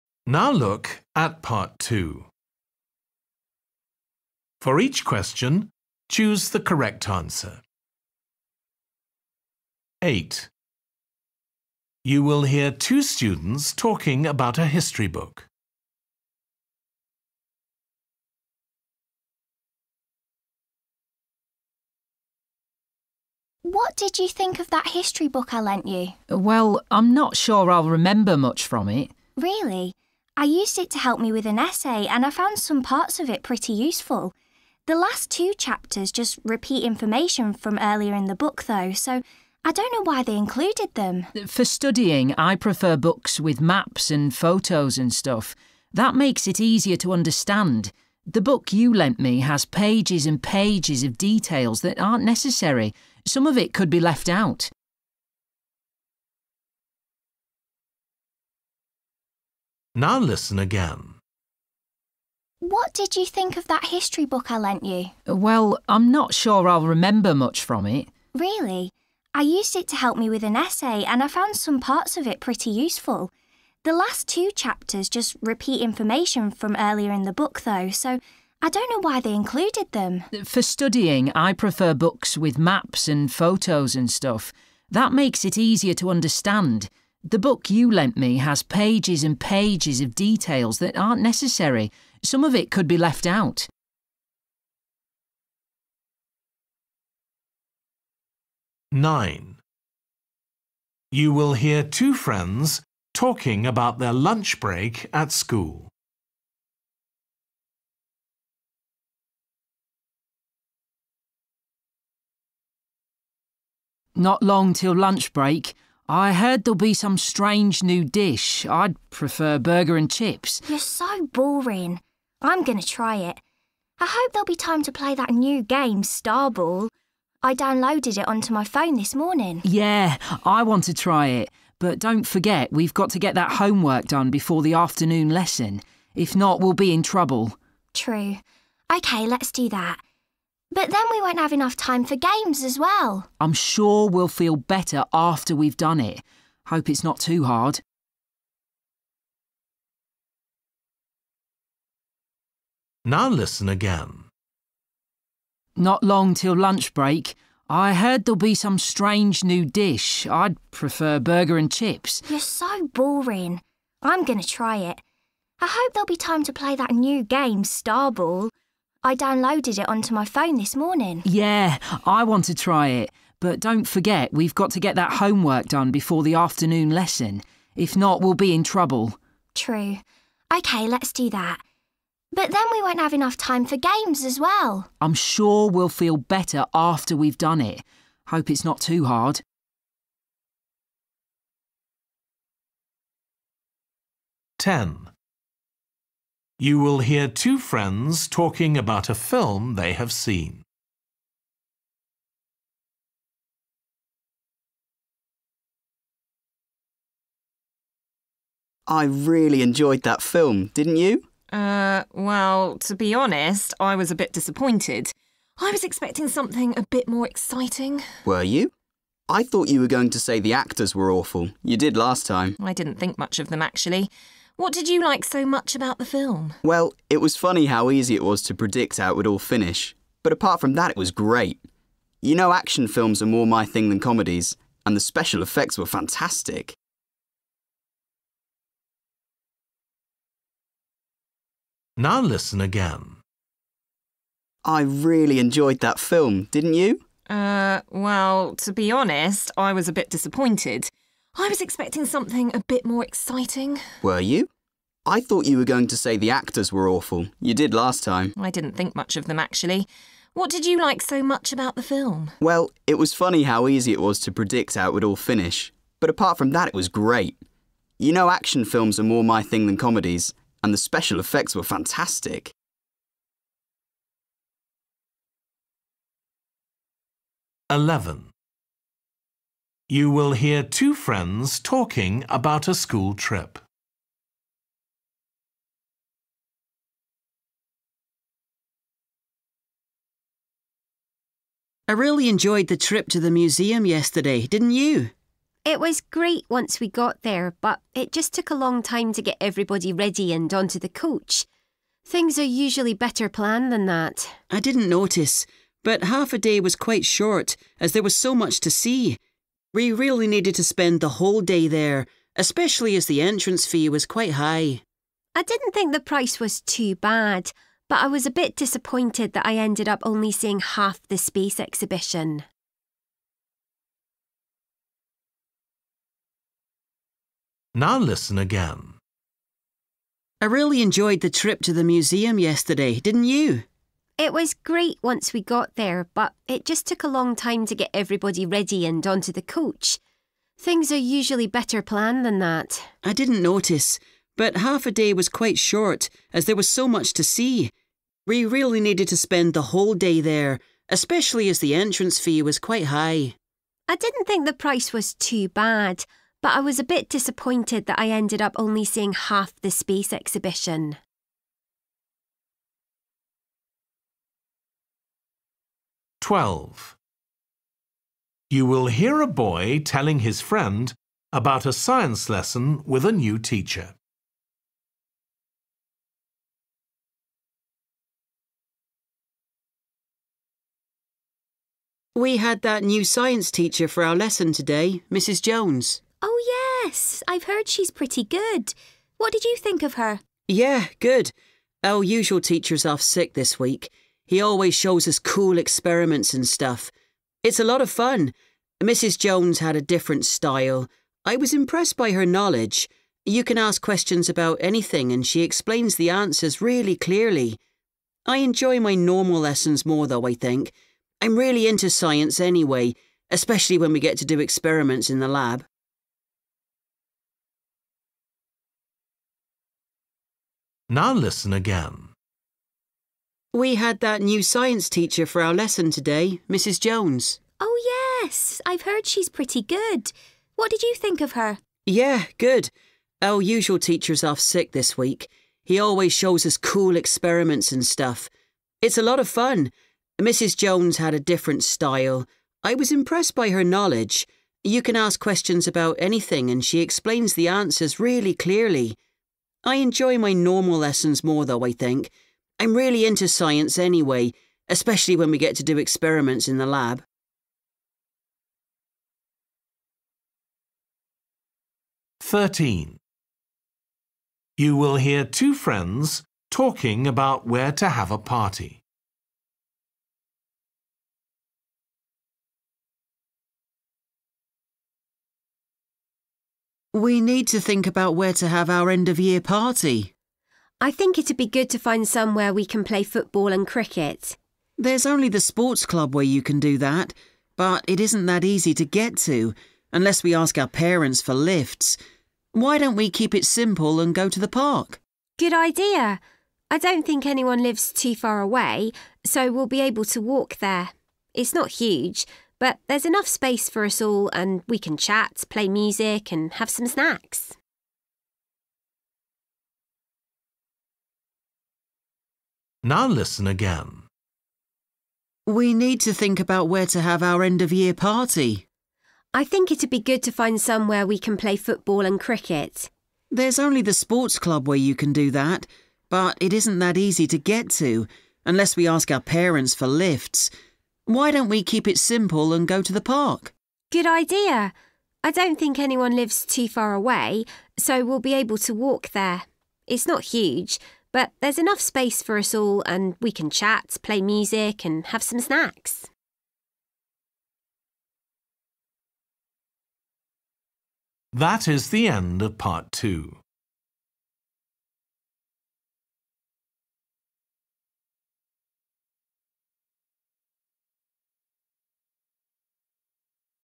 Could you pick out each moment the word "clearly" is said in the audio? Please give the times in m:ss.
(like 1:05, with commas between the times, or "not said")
6:46, 7:28.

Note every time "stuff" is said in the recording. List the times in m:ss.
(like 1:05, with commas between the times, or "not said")
0:45, 1:24, 6:36, 7:17.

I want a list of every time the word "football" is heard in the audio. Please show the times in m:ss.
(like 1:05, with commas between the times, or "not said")
8:03, 8:41.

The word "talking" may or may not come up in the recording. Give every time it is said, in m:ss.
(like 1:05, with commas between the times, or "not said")
0:13, 1:43, 3:18, 4:41, 7:46.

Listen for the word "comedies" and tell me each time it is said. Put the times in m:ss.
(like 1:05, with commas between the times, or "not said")
3:53, 4:29.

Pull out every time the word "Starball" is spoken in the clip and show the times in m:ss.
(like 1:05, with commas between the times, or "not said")
2:06, 2:47.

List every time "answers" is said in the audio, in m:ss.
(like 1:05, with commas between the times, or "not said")
0:07, 6:46, 7:27.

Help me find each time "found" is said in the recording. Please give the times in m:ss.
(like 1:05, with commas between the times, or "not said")
0:32, 1:11.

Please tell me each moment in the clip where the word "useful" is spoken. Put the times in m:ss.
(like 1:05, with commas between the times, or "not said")
0:33, 1:12.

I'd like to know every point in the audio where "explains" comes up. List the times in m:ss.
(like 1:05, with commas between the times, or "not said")
6:45, 7:26.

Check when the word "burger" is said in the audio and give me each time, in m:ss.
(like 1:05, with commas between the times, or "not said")
1:59, 2:41.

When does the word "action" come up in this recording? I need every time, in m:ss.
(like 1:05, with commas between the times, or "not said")
3:52, 4:28.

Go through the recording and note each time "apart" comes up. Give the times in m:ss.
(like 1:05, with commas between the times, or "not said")
3:50, 4:26.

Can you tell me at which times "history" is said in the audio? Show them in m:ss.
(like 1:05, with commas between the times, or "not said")
0:14, 0:24, 1:03.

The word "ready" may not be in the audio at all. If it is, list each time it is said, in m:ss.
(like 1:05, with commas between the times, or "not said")
4:59, 5:38.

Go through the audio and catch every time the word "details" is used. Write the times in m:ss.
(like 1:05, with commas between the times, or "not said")
0:51, 1:30.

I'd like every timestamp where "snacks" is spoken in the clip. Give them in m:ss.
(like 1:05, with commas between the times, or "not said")
8:26, 9:05.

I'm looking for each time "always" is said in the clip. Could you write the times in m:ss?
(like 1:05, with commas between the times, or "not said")
6:34, 7:15.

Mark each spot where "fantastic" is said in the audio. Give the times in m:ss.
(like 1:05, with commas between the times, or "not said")
3:55, 4:31.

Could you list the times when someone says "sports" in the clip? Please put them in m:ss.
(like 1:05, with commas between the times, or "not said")
8:05, 8:43.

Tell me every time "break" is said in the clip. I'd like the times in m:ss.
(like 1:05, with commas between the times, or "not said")
1:44, 1:55, 2:36.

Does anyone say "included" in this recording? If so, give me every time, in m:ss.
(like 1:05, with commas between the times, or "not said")
0:40, 1:19.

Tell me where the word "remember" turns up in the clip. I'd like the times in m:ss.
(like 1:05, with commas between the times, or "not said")
0:27, 1:06.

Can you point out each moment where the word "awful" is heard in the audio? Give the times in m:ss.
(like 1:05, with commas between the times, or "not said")
3:41, 4:16.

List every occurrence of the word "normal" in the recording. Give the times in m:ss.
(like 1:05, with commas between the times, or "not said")
6:48, 7:30.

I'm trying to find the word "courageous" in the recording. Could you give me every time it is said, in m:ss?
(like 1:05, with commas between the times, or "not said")
not said.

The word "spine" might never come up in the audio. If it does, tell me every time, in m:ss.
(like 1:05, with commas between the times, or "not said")
not said.